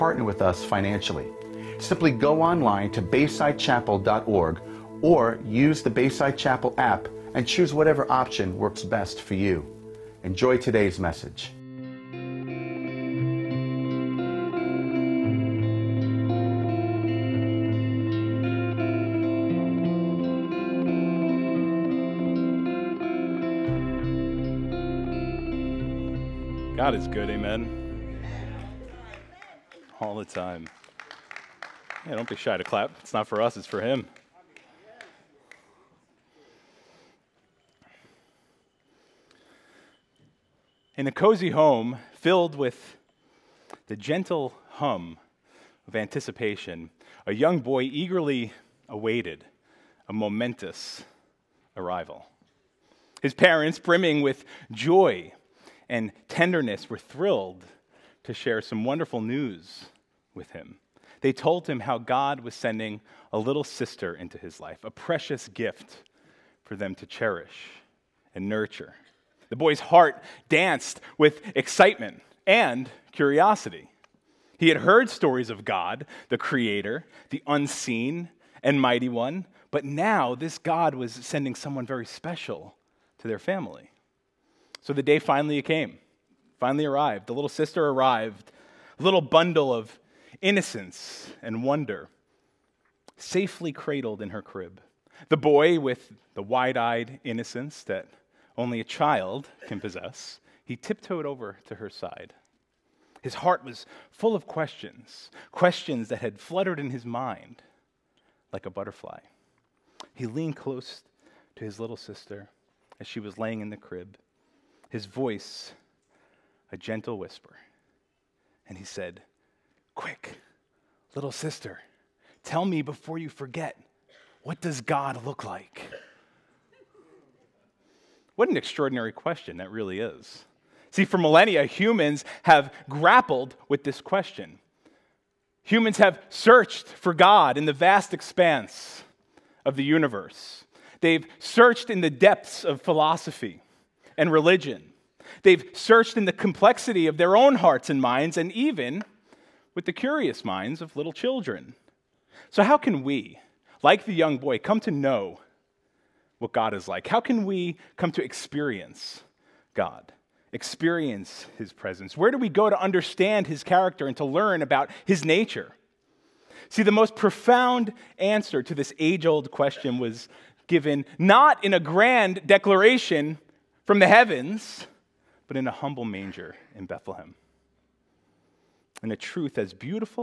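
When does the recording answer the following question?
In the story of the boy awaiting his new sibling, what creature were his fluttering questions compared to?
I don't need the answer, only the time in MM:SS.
01:48.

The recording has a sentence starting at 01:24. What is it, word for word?
So the day finally came, finally arrived.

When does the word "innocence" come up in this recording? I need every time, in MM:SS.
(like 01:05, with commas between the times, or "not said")
01:30, 01:37.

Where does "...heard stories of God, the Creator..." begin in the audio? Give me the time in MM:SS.
01:14.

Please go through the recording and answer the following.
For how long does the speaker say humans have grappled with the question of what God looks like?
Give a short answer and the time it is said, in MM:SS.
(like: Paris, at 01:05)
Millennia, at 02:11.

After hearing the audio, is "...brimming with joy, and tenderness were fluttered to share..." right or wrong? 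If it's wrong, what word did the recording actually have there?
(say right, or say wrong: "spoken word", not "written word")
wrong: "thrilled", not "fluttered".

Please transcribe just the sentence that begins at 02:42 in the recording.
Where do we go to understand His character and to learn about His nature?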